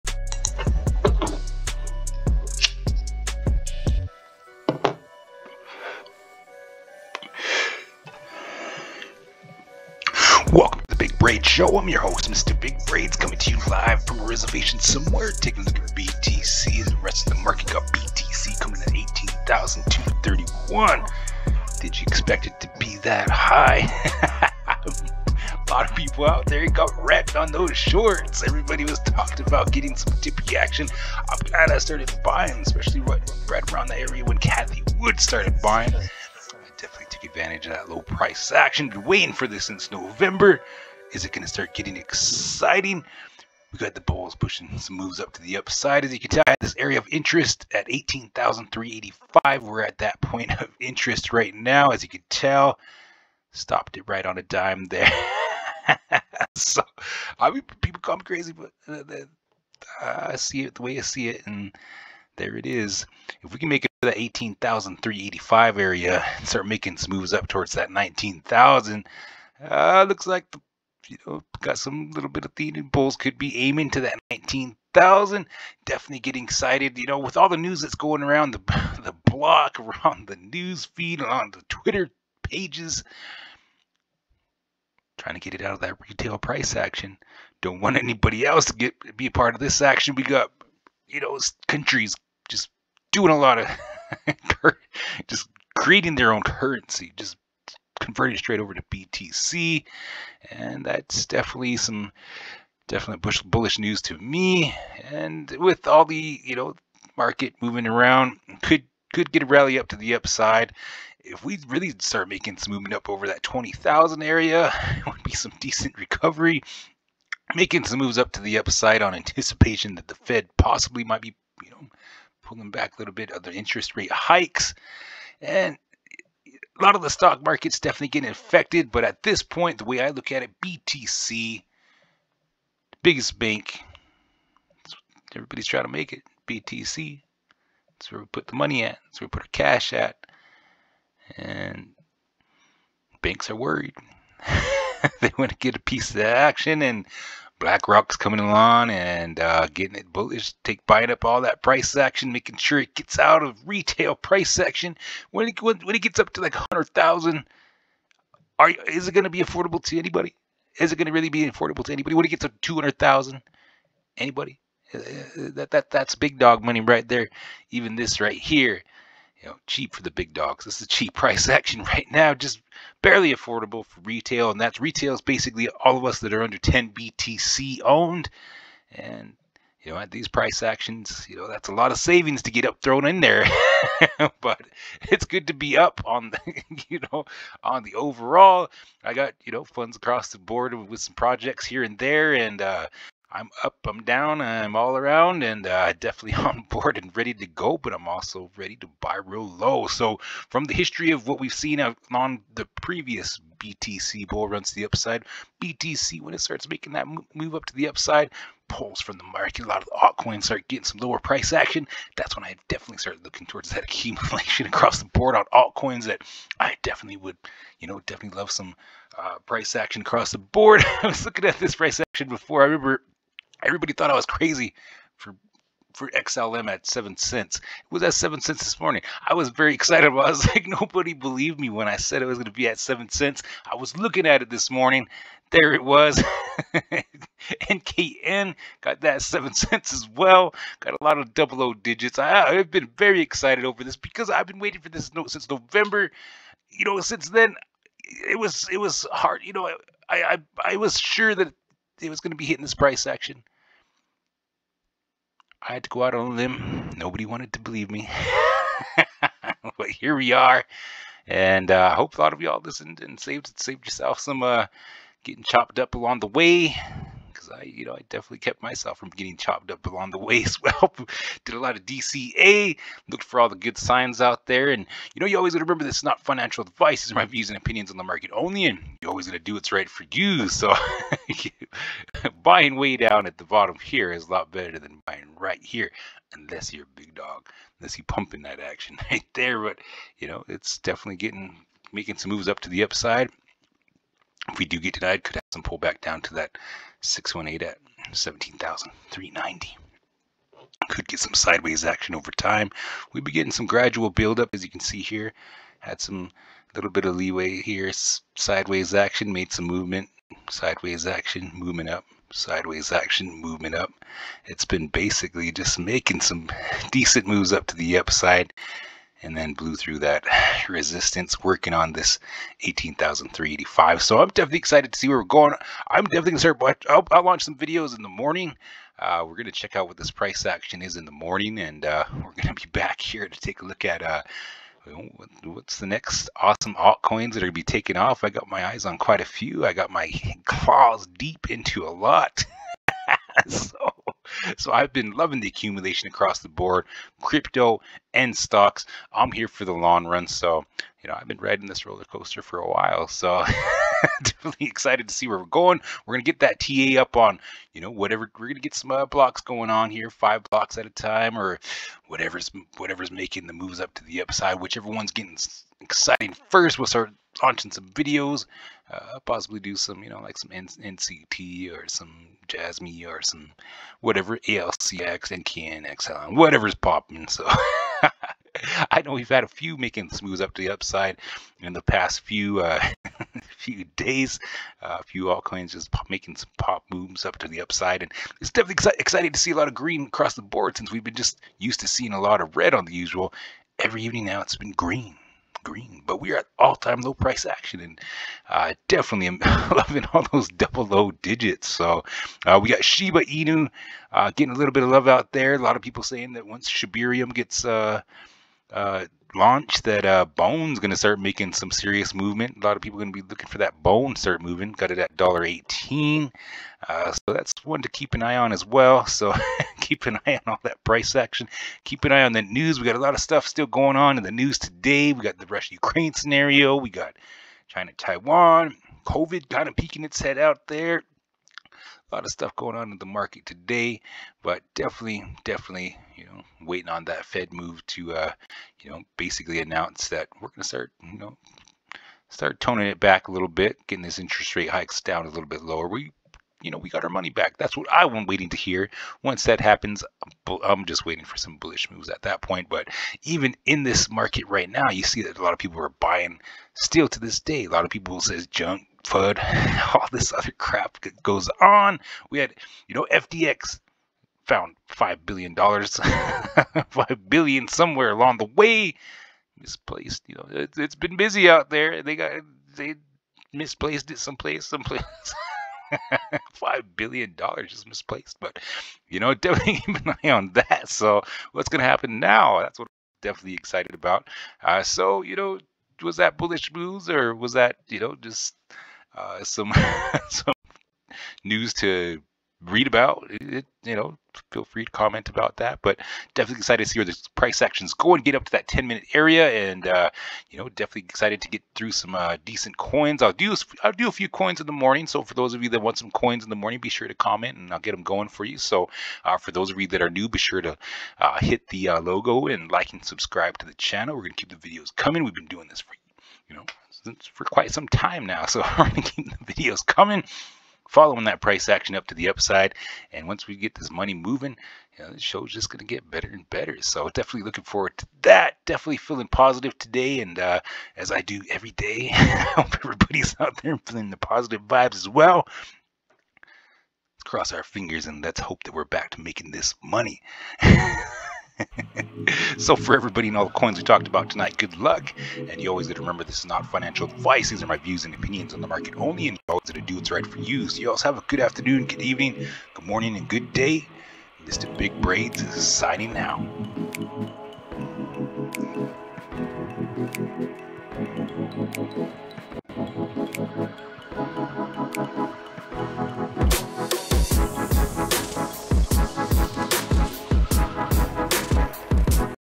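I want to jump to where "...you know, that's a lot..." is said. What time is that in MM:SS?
03:01.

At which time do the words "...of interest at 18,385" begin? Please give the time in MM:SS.
00:46.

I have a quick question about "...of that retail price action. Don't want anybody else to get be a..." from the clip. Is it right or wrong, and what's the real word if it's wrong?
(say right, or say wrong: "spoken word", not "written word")
right.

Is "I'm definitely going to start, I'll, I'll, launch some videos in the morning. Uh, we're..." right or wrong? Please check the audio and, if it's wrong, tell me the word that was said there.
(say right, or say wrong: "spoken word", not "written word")
right.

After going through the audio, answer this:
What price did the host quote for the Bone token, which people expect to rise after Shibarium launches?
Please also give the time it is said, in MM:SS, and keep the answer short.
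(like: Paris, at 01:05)
$1.18, at 06:55.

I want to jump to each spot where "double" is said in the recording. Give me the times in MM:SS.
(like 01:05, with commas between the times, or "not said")
04:01, 06:40.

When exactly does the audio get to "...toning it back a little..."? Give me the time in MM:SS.
07:22.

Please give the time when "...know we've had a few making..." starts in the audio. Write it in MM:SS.
06:19.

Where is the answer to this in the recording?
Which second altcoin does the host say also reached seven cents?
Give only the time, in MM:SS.
03:57.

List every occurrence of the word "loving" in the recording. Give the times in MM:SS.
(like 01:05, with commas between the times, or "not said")
05:45, 06:39.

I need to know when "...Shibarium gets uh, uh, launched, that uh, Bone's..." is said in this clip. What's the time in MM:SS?
06:46.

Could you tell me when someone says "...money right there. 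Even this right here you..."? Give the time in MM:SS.
02:46.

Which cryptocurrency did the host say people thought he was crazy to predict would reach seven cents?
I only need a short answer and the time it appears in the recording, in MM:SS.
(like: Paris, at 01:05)
XLM, at 03:46.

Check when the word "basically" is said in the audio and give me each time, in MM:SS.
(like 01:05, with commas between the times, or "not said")
02:55, 05:14, 07:19.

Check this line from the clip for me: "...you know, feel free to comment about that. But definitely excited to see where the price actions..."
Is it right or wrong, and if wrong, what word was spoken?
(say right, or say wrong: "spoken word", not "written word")
right.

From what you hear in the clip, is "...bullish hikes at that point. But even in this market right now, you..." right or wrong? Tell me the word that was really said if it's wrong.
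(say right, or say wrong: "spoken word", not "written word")
wrong: "moves", not "hikes".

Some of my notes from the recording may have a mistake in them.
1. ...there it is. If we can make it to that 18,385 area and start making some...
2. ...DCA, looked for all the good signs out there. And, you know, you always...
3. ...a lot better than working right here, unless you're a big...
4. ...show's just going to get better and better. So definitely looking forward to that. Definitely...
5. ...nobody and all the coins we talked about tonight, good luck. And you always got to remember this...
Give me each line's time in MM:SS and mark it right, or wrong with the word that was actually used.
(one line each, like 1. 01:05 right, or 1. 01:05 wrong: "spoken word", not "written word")
1. 01:02 right
2. 04:31 right
3. 04:44 wrong: "buying", not "working"
4. 08:45 right
5. 09:02 wrong: "everybody", not "nobody".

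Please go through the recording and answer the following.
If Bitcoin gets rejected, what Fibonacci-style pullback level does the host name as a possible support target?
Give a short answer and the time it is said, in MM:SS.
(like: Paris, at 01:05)
17,390, at 04:58.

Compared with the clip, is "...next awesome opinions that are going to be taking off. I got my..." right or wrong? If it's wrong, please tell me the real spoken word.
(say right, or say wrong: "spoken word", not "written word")
wrong: "altcoins", not "opinions".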